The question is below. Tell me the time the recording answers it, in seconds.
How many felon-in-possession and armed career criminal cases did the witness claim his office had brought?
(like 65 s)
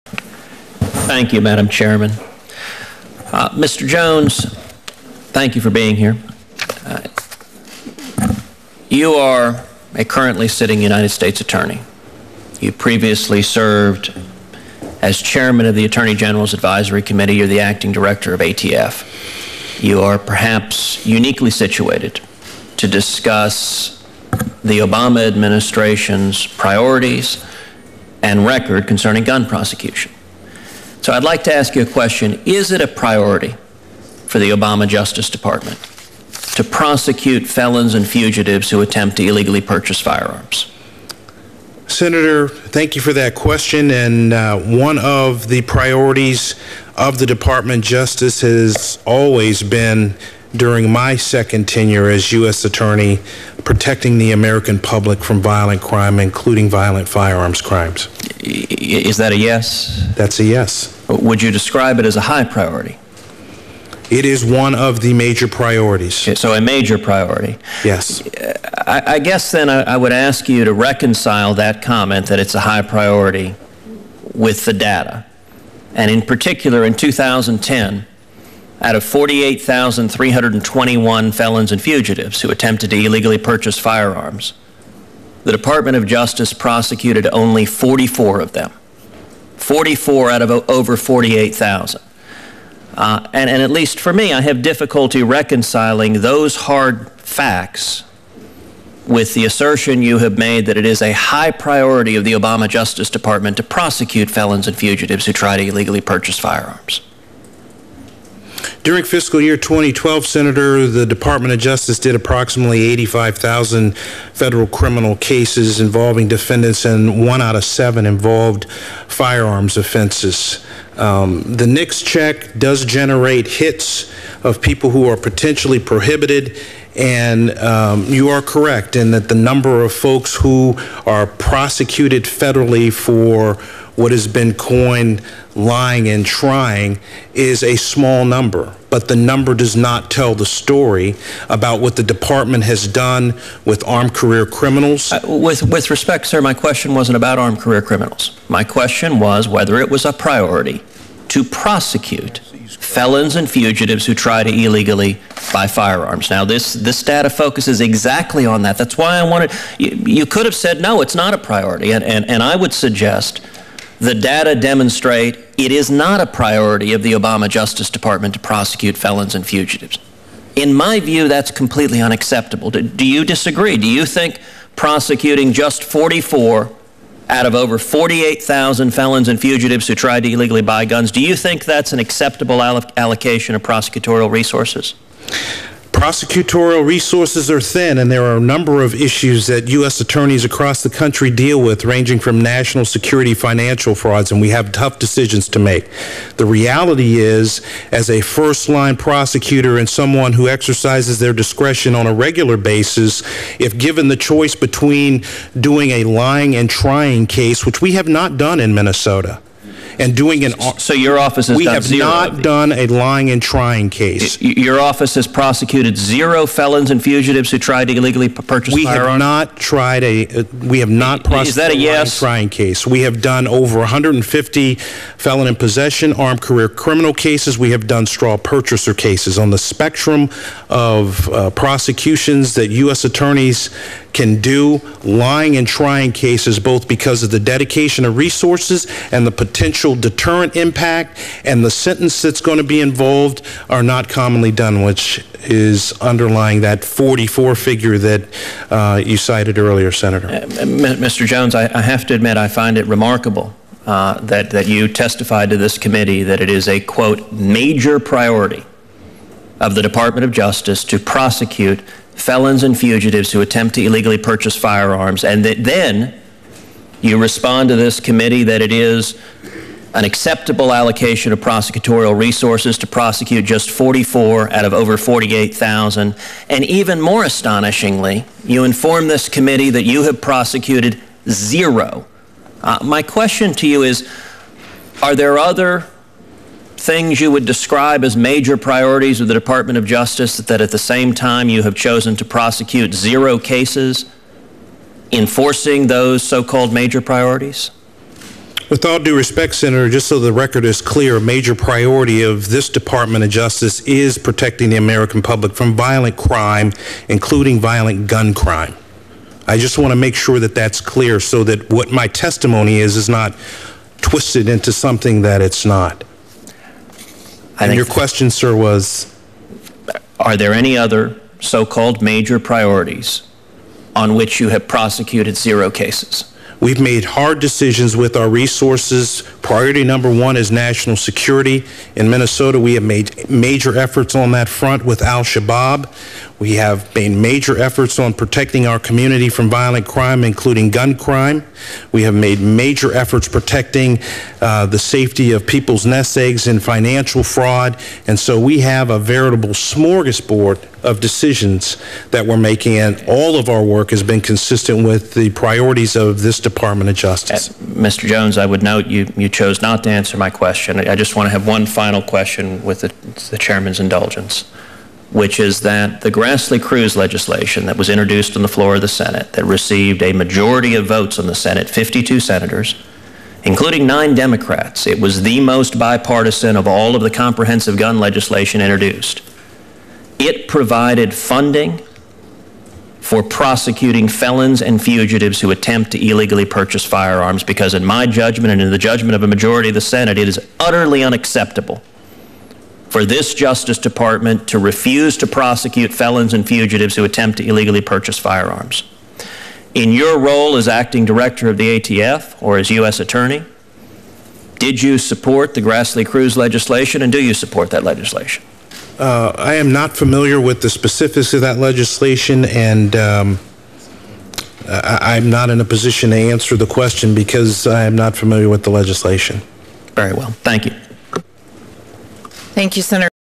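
223 s.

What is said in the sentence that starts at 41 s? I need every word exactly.
Senator, thank you for that question.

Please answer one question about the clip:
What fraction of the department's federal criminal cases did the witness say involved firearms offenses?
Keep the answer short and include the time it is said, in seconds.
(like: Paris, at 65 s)
1 in 7, at 117 s.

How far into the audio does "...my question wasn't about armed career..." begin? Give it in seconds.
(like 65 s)
146 s.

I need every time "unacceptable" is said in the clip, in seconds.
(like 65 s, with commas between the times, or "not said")
172 s, 391 s.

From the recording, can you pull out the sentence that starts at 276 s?
And even more astonishingly, you inform this committee that you have prosecuted zero.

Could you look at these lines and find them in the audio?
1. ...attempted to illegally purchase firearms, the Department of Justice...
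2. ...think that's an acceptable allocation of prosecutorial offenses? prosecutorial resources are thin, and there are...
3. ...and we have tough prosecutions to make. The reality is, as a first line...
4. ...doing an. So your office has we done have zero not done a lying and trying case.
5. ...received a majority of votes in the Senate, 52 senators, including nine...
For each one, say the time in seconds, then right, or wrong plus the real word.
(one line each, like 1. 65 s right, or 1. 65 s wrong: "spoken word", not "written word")
1. 82 s right
2. 181 s wrong: "resources", not "offenses"
3. 194 s wrong: "decisions", not "prosecutions"
4. 210 s right
5. 369 s right.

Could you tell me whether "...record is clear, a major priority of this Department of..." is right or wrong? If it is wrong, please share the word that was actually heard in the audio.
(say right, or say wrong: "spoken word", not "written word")
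right.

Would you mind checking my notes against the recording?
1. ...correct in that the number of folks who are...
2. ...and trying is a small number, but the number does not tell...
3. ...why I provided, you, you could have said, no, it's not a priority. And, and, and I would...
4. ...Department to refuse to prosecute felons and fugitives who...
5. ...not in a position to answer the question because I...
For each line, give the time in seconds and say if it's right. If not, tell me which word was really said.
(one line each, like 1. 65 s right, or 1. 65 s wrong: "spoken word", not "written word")
1. 128 s right
2. 136 s right
3. 158 s wrong: "wanted", not "provided"
4. 393 s right
5. 415 s right.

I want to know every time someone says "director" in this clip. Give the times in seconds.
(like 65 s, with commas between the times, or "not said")
17 s, 401 s.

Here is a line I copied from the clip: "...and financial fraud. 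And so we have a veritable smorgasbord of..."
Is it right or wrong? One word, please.
right.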